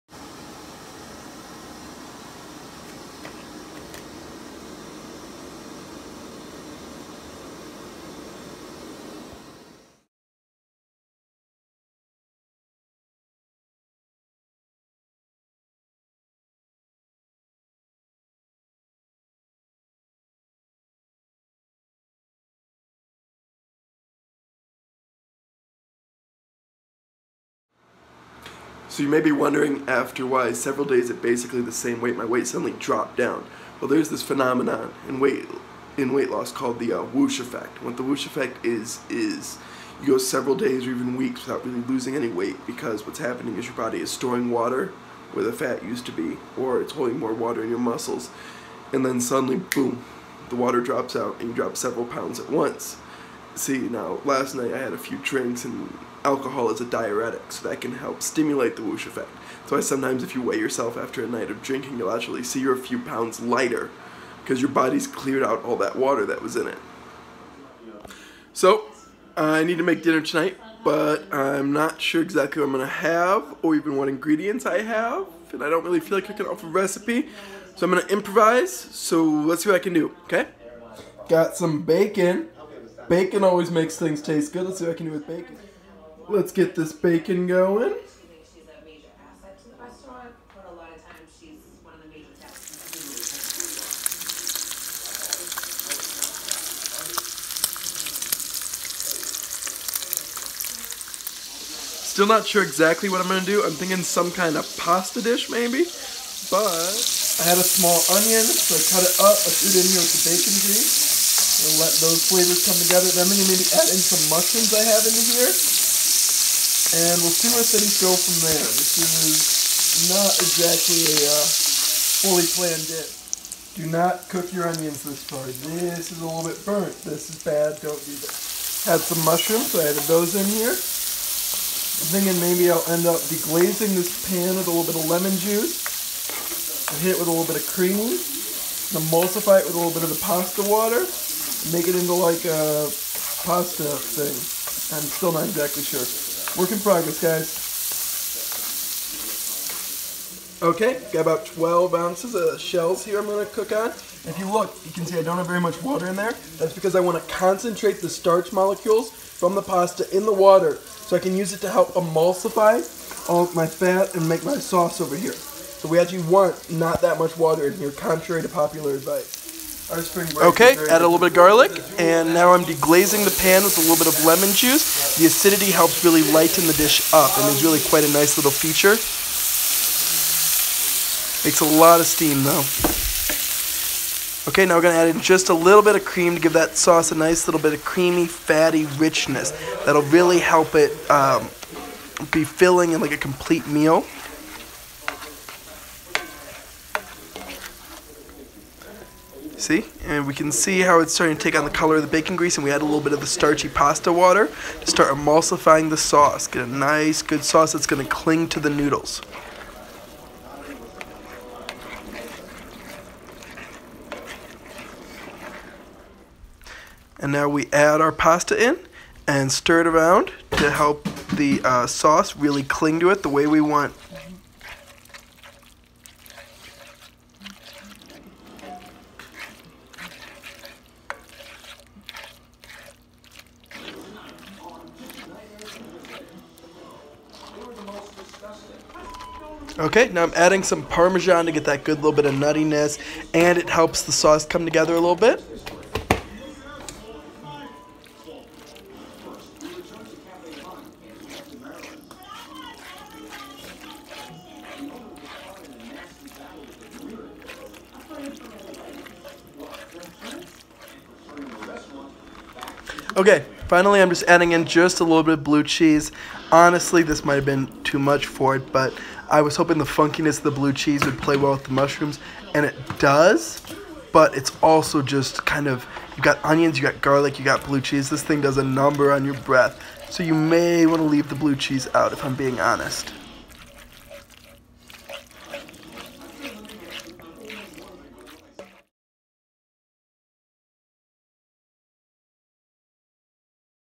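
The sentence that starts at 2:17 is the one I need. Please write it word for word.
hit it with a little bit of cream.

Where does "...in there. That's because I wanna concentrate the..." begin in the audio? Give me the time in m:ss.
2:36.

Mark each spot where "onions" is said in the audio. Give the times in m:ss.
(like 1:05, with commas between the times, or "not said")
1:48, 2:04, 4:36.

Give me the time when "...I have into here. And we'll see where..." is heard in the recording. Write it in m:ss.
1:54.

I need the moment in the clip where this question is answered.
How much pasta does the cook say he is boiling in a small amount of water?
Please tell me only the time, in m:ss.
2:31.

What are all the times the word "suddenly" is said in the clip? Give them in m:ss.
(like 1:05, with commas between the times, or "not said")
0:32, 0:49.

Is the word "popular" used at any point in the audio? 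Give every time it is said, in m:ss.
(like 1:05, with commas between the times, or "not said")
2:48.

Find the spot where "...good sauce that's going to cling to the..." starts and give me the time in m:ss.
3:27.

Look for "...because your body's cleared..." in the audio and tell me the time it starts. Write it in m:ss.
1:04.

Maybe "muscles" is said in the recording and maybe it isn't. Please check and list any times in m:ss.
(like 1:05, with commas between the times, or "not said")
0:47.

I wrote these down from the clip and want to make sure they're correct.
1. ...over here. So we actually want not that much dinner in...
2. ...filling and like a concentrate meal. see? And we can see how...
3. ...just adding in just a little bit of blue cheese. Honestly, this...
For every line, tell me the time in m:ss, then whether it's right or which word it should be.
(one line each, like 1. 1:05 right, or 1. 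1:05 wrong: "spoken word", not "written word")
1. 2:45 wrong: "water", not "dinner"
2. 3:12 wrong: "complete", not "concentrate"
3. 4:24 right.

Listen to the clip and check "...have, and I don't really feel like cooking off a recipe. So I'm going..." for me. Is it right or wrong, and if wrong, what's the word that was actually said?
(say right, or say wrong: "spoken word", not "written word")
right.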